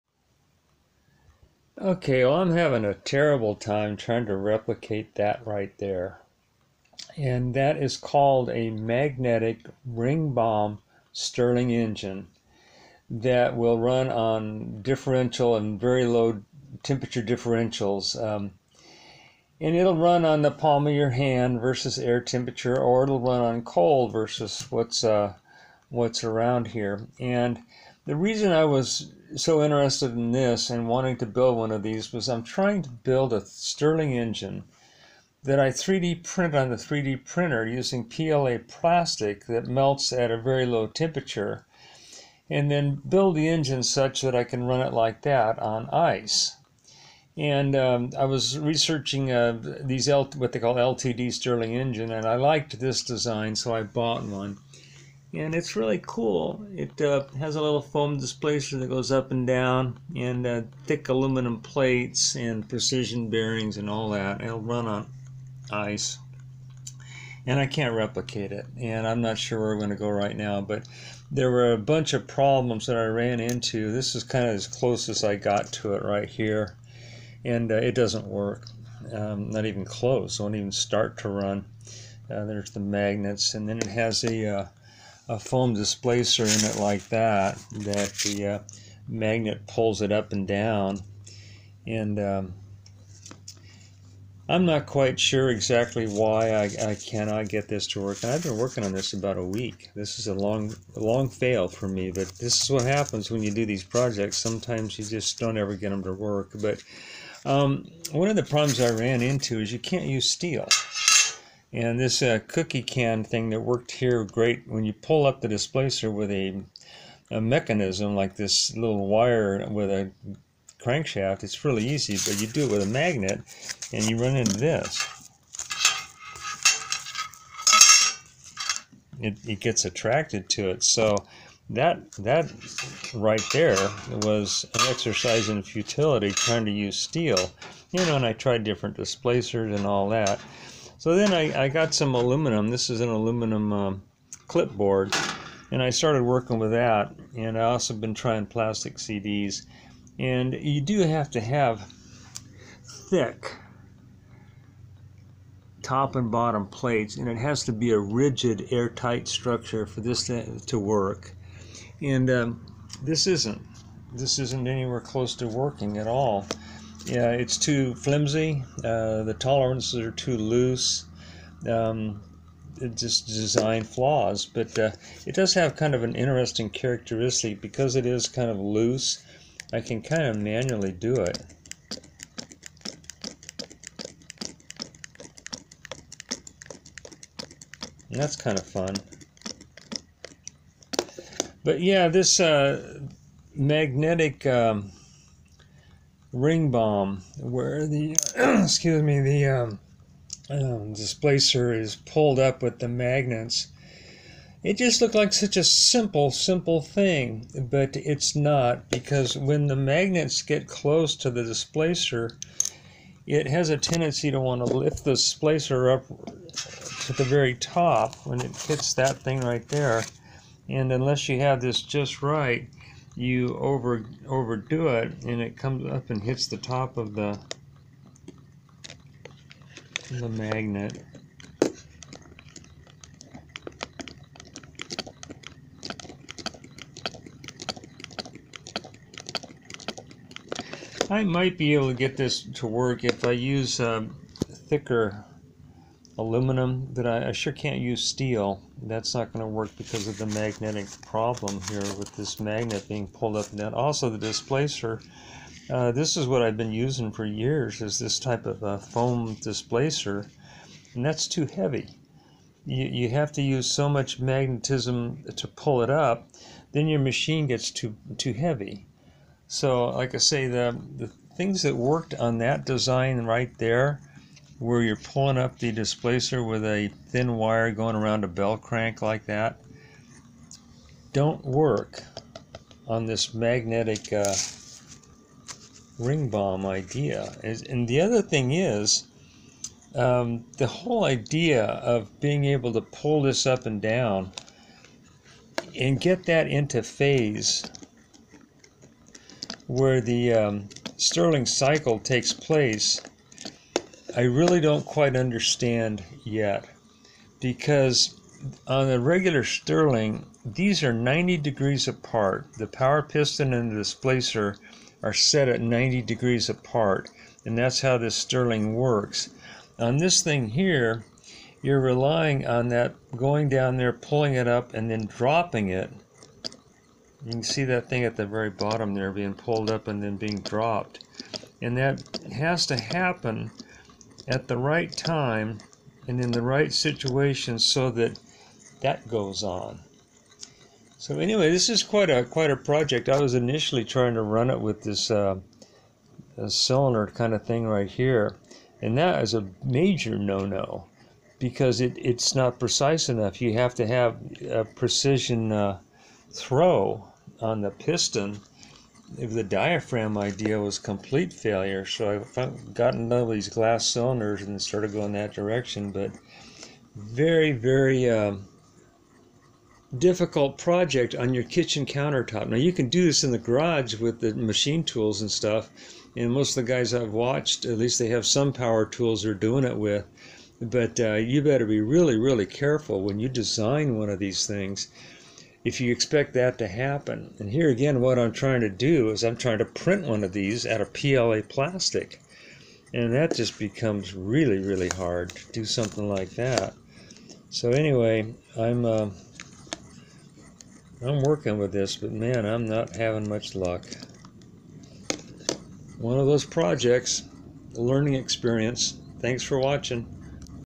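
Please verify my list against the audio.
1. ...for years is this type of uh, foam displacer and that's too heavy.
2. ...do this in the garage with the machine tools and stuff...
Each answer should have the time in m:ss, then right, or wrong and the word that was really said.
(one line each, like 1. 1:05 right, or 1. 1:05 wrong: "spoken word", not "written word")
1. 4:17 right
2. 6:12 right.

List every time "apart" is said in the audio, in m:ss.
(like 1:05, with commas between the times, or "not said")
5:11, 5:16.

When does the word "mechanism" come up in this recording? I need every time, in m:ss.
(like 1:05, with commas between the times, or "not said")
1:57.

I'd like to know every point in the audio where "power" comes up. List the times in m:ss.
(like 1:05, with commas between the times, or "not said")
5:12, 6:18.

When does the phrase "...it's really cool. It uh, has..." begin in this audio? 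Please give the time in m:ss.
0:55.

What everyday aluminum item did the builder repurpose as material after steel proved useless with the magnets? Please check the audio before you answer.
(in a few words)
clipboard.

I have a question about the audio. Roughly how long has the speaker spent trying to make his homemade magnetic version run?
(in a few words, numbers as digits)
about a week.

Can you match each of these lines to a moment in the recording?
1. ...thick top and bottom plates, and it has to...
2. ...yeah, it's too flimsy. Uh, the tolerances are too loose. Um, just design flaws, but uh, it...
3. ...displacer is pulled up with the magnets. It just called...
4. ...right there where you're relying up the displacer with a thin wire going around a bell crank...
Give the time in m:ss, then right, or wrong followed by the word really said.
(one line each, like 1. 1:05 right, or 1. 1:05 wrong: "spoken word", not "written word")
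1. 2:33 right
2. 2:47 right
3. 3:20 wrong: "looked", not "called"
4. 4:33 wrong: "pulling", not "relying".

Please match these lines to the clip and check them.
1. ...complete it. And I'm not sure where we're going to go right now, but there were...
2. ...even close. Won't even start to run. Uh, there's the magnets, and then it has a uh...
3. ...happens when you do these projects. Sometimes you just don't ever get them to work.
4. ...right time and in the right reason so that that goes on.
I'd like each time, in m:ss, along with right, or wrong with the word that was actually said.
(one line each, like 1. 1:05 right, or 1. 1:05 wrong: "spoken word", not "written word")
1. 1:07 wrong: "replicate", not "complete"
2. 1:19 right
3. 1:42 right
4. 5:34 wrong: "situation", not "reason".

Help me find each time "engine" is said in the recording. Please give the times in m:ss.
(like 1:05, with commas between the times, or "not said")
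0:11, 0:34, 0:43, 0:51.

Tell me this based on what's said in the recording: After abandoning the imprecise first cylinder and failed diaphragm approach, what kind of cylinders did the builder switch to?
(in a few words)
glass cylinders.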